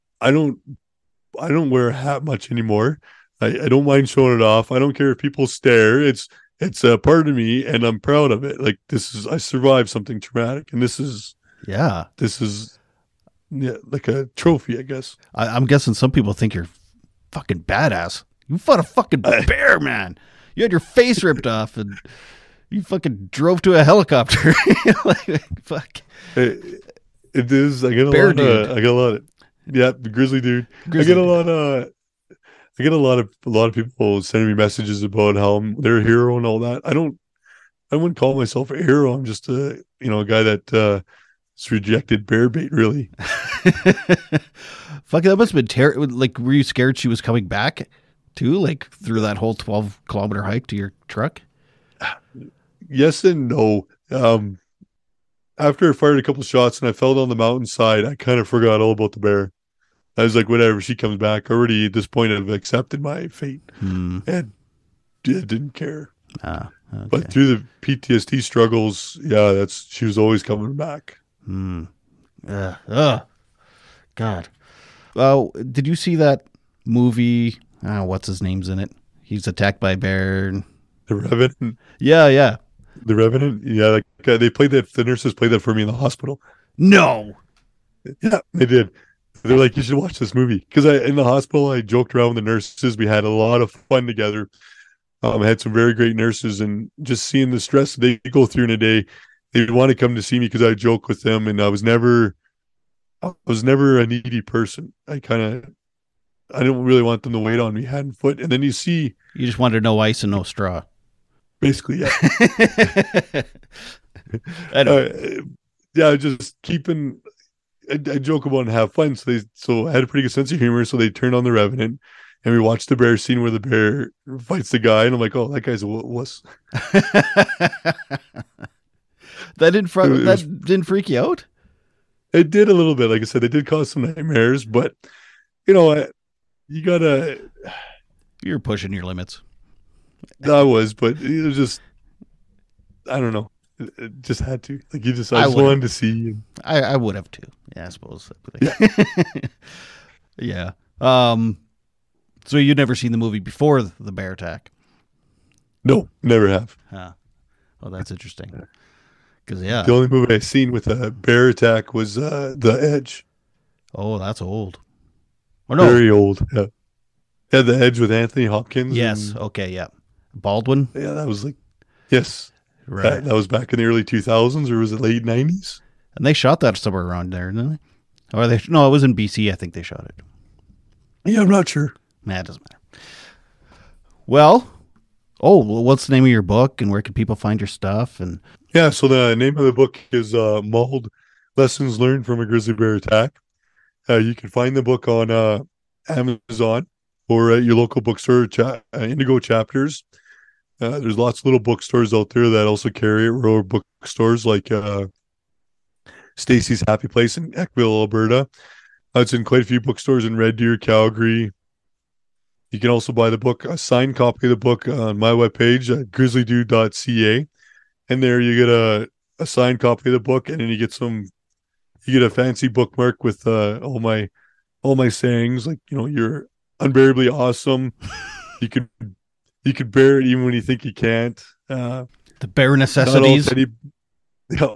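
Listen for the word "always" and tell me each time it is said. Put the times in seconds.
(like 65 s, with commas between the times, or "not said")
70 s.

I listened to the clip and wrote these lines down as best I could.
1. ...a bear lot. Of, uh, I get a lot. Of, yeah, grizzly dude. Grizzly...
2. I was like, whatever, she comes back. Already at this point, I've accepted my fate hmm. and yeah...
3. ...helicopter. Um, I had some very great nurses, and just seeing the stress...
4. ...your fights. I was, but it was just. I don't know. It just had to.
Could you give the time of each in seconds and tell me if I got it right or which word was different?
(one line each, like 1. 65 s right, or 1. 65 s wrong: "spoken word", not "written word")
1. 28 s right
2. 60 s right
3. 94 s wrong: "together", not "helicopter"
4. 138 s wrong: "limits", not "fights".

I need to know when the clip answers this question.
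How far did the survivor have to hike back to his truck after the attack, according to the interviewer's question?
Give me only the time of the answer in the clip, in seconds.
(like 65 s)
49 s.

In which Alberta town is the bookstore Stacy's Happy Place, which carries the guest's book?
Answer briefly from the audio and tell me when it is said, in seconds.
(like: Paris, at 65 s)
Eckville, at 207 s.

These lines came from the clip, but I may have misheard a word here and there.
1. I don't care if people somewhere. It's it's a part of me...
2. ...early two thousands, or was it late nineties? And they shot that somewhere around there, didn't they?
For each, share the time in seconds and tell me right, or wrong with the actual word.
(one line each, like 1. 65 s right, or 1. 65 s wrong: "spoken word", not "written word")
1. 4 s wrong: "stare", not "somewhere"
2. 173 s right.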